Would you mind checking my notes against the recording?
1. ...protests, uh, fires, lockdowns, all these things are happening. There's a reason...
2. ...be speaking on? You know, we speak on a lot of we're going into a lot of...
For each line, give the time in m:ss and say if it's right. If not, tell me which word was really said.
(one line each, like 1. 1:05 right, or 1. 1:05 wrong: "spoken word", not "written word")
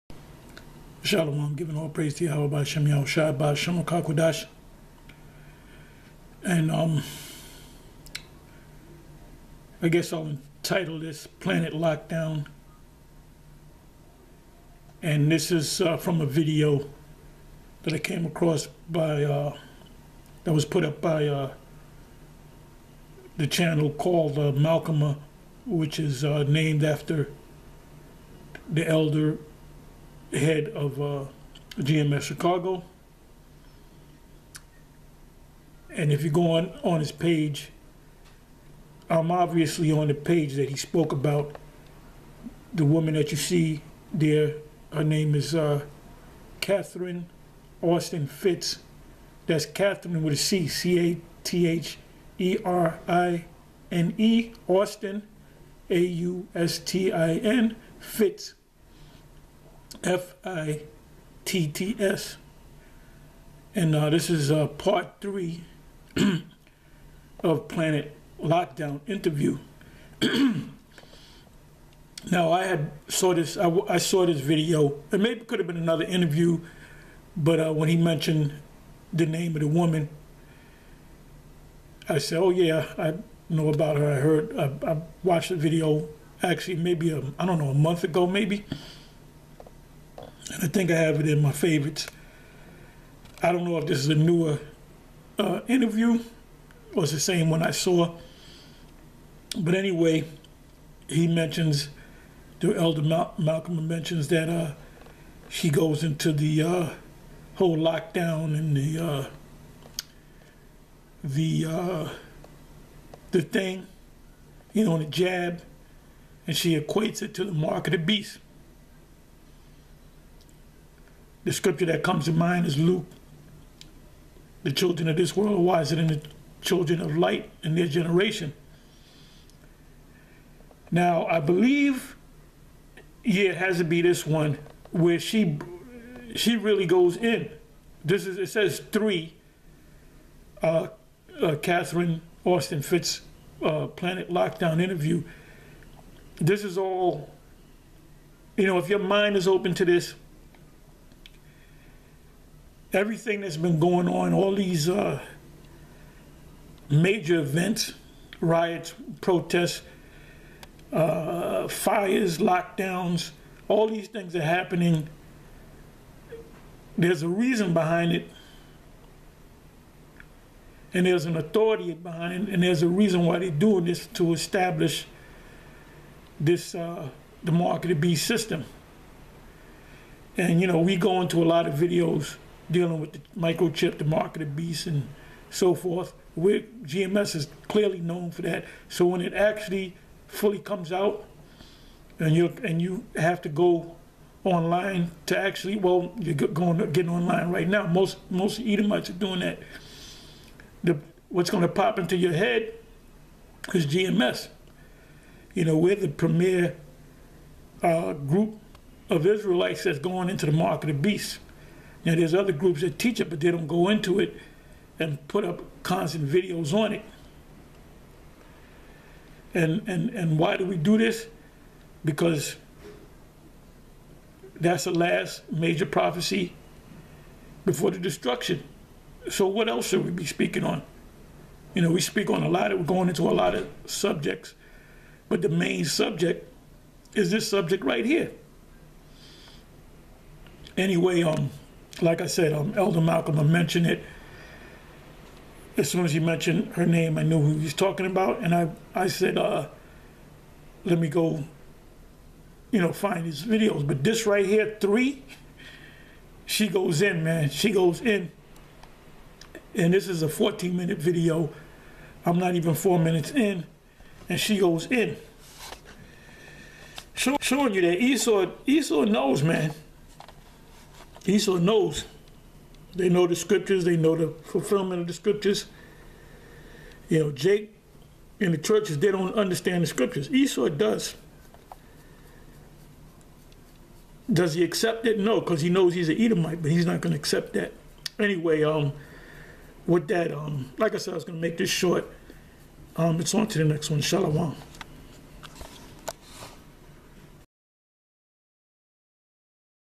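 1. 2:39 right
2. 3:50 right.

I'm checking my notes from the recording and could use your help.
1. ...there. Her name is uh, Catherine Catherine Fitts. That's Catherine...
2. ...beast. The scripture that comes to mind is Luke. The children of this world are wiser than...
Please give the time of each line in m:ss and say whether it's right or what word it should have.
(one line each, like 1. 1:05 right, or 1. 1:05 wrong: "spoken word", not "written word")
1. 0:44 wrong: "Austin", not "Catherine"
2. 1:57 right.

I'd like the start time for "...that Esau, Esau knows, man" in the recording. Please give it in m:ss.
4:27.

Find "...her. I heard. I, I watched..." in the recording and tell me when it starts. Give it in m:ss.
1:23.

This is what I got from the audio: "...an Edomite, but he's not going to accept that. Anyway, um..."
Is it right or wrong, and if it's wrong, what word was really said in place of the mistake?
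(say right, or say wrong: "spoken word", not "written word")
right.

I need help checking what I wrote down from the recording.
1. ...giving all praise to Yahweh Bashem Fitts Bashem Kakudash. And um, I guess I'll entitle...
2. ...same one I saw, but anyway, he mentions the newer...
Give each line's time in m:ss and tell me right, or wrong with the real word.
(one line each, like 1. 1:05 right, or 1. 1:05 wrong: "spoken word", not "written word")
1. 0:01 wrong: "Yahushai", not "Fitts"
2. 1:37 wrong: "elder", not "newer".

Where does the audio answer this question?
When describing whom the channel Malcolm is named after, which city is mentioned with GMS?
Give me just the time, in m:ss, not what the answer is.
0:32.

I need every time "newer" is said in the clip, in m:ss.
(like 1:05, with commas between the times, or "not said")
1:34.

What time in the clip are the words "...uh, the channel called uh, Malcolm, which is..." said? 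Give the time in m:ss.
0:21.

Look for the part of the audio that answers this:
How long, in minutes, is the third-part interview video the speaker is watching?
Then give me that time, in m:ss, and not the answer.
4:20.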